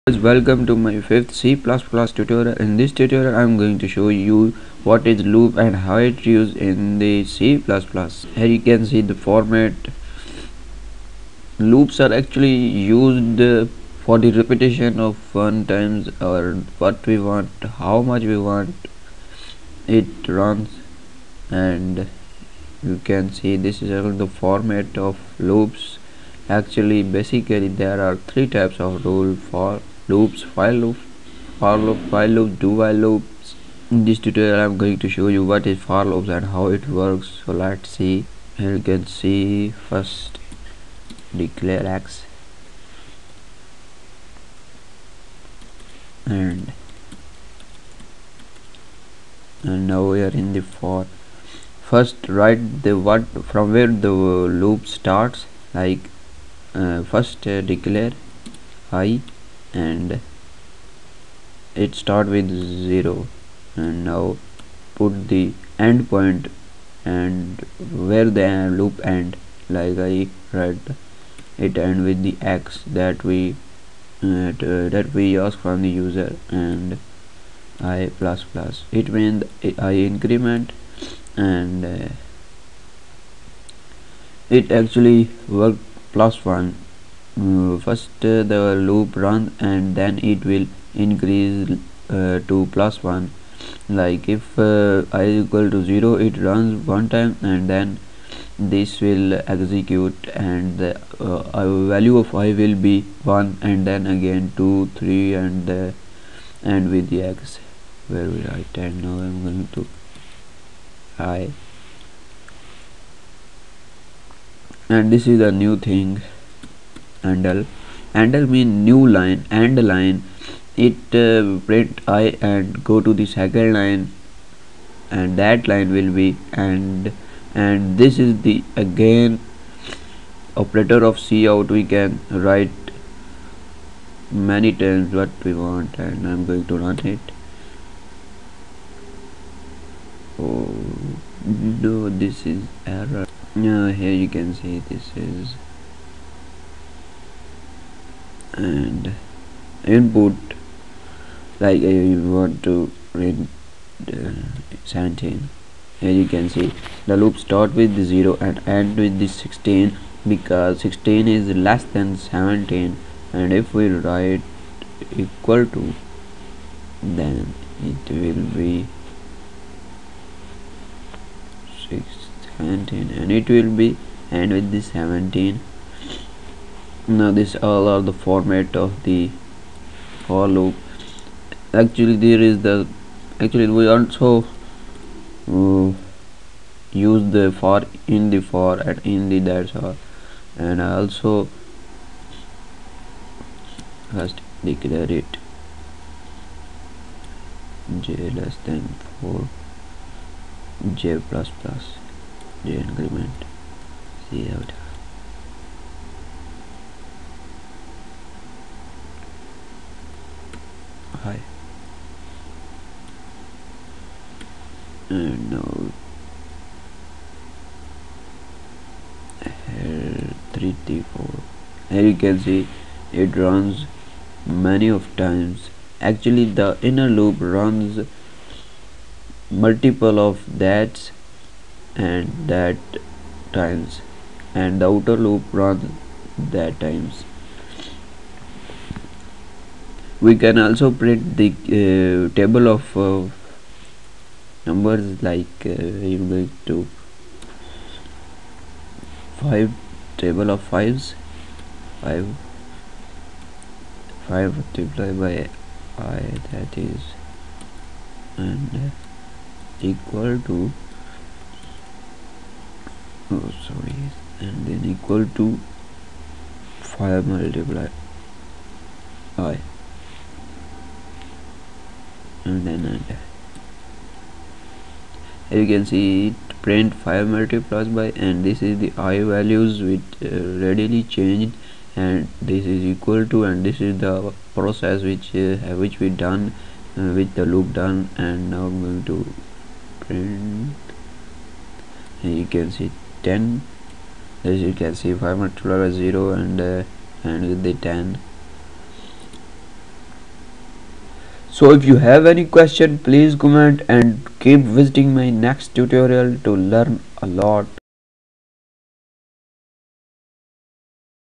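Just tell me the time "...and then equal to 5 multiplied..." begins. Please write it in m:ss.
4:24.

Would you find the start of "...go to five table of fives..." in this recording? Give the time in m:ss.
4:06.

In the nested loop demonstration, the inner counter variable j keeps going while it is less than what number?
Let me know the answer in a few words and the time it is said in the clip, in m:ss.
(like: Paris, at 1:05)
4, at 3:19.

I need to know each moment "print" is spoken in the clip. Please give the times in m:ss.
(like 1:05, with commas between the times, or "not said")
2:01, 4:00, 4:36, 4:49.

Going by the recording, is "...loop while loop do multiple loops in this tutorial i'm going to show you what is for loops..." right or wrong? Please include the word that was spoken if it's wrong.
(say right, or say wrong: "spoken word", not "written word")
wrong: "while", not "multiple".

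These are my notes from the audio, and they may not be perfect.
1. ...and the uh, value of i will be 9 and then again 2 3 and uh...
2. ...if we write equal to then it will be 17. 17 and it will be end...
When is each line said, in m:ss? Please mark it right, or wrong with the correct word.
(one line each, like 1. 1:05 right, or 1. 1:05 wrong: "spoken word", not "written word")
1. 1:40 wrong: "1", not "9"
2. 2:43 wrong: "16", not "17".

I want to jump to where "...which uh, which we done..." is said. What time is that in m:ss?
4:45.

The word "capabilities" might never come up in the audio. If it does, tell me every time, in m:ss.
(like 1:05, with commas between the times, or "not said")
not said.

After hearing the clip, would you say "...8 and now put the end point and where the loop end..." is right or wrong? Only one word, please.
wrong.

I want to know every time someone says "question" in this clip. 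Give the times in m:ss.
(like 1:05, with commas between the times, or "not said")
5:02.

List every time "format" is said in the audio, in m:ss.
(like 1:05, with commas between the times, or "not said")
0:09, 0:24, 2:58.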